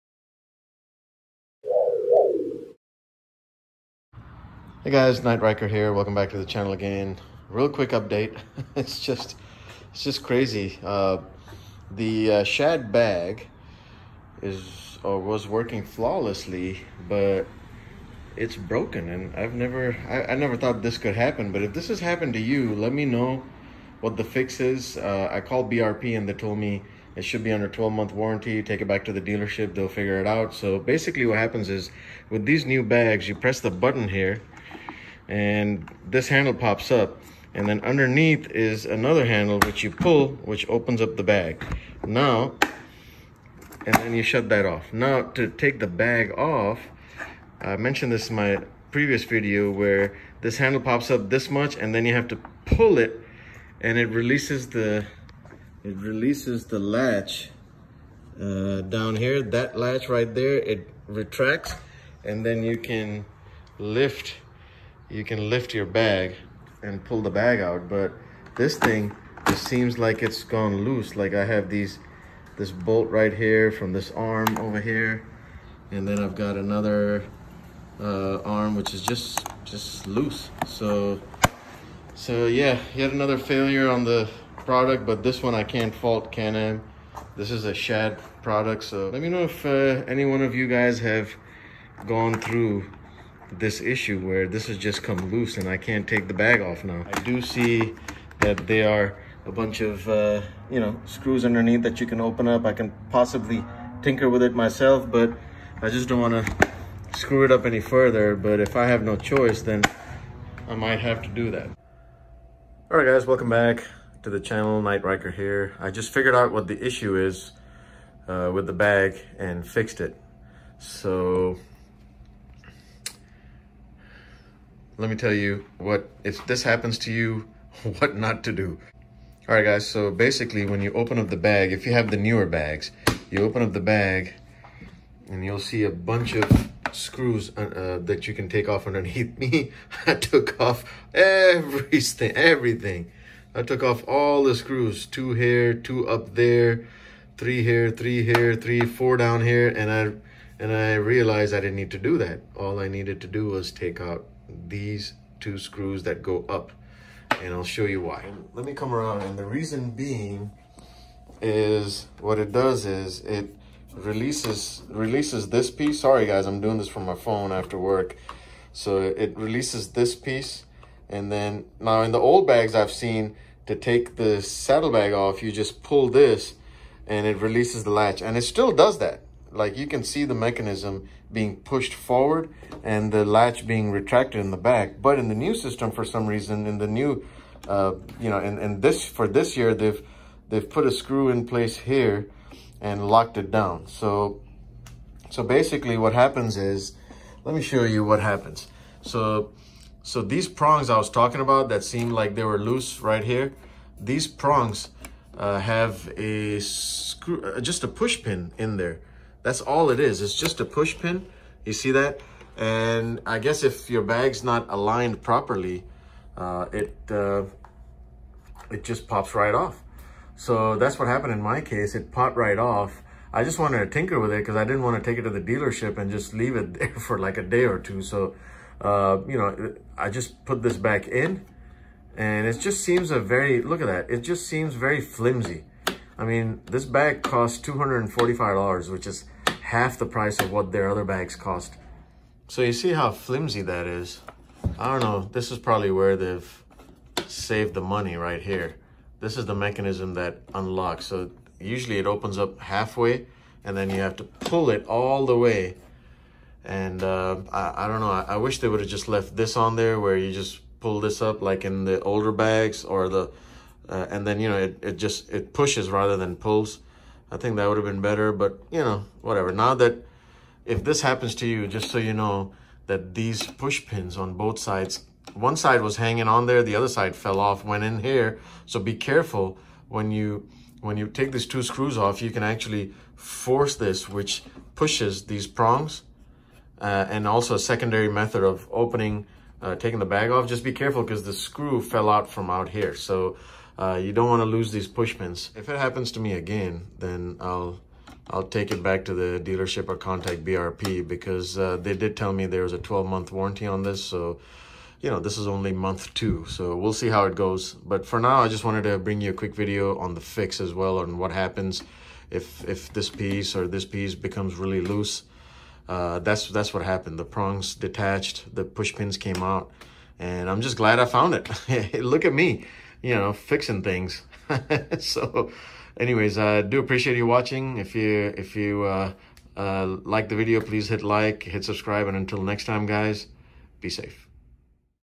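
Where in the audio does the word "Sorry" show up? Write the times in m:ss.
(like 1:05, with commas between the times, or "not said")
2:46.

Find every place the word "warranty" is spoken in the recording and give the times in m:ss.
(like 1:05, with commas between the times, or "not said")
0:28, 5:03.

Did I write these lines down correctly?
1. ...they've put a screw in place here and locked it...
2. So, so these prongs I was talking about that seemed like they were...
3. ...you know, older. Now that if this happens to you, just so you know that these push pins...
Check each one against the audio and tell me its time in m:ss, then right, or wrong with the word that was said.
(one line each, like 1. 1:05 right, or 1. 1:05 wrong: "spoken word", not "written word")
1. 3:10 right
2. 3:19 right
3. 4:28 wrong: "whatever", not "older".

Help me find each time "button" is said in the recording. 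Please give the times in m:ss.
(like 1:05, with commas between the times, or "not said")
0:33.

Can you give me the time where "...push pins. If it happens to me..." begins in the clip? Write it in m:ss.
4:54.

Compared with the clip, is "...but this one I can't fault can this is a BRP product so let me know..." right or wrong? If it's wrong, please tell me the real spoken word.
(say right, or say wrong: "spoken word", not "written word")
wrong: "Shad", not "BRP".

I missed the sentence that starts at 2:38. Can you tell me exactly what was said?
Let me come around and the reason being is what it does is it releases releases this piece.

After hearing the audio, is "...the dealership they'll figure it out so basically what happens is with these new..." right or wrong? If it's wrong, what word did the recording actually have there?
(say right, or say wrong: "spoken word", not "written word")
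right.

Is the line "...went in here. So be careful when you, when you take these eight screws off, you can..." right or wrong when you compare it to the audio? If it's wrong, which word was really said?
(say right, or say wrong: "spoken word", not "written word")
wrong: "two", not "eight".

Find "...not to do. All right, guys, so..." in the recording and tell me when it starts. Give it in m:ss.
2:08.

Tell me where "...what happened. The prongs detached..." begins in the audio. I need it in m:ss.
5:16.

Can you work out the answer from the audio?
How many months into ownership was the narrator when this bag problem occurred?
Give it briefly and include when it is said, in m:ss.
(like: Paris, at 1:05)
2, at 5:05.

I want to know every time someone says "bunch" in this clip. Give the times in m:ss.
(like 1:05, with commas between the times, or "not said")
1:39, 2:15.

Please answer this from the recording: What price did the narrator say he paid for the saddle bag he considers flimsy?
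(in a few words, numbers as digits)
$245.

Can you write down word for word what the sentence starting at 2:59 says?
Like you can see the mechanism being pushed forward and the latch being retracted in the back.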